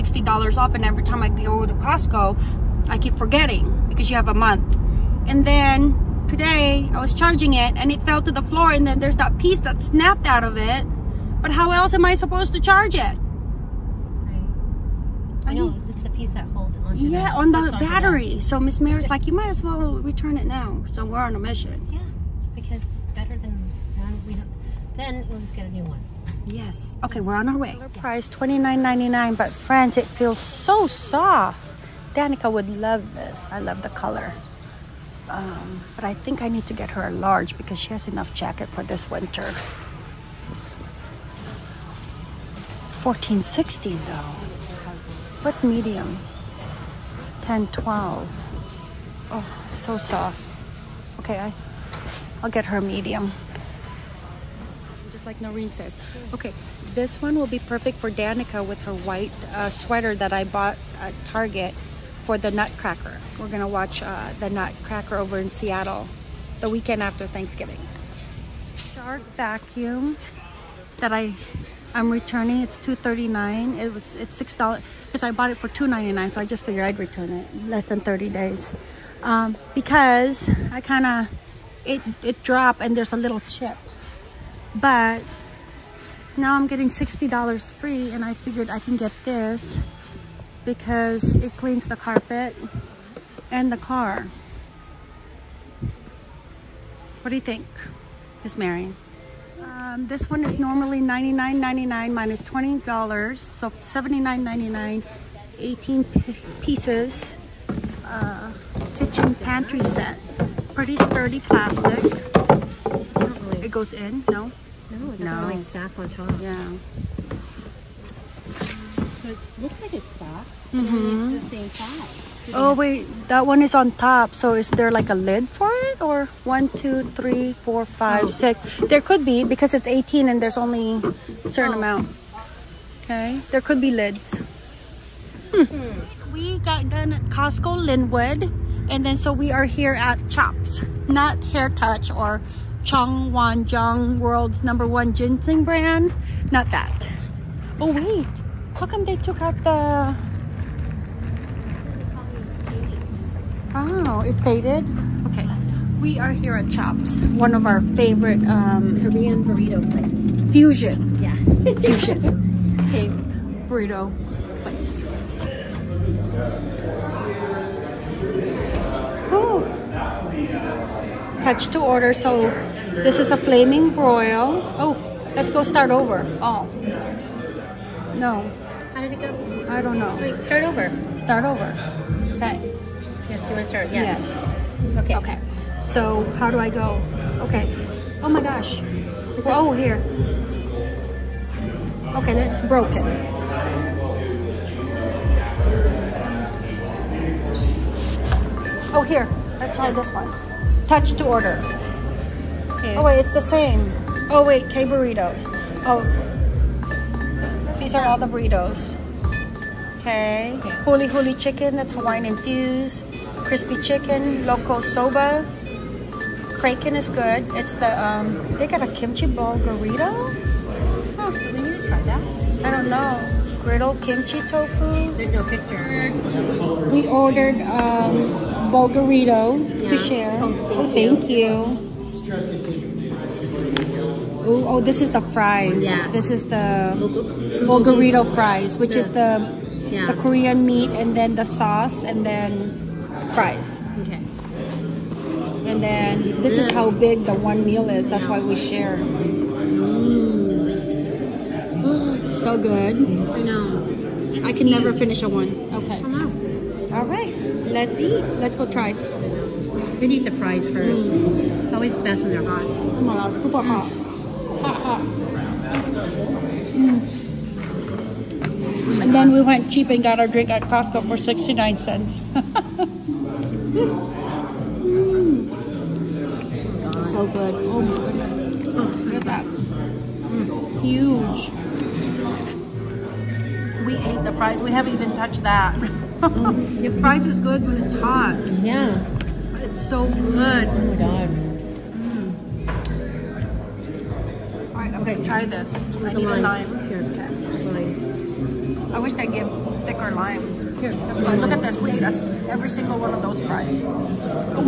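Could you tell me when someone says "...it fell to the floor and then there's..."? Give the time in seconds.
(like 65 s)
7 s.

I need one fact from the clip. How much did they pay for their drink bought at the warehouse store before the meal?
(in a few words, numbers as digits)
69 cents.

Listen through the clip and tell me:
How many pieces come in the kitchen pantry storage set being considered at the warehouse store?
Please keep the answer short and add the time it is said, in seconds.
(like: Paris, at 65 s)
18, at 105 s.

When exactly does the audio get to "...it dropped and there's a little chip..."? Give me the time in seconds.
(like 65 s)
82 s.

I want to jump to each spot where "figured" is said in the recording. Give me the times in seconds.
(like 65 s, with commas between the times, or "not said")
76 s, 88 s.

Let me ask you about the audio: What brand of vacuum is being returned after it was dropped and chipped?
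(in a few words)
Shark.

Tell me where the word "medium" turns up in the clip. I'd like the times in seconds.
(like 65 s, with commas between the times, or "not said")
45 s, 52 s.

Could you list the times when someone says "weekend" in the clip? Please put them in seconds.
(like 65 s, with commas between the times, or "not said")
66 s.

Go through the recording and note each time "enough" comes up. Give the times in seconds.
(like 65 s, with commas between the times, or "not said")
38 s.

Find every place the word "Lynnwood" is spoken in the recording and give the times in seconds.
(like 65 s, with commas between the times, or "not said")
137 s.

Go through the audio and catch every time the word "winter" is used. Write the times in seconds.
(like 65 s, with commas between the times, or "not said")
39 s.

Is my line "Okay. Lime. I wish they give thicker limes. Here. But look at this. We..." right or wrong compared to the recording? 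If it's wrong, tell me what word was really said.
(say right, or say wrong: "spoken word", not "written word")
right.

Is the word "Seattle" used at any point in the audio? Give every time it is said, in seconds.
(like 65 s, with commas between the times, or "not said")
65 s.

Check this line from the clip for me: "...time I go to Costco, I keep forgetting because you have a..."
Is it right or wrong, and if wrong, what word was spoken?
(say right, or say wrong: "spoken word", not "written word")
right.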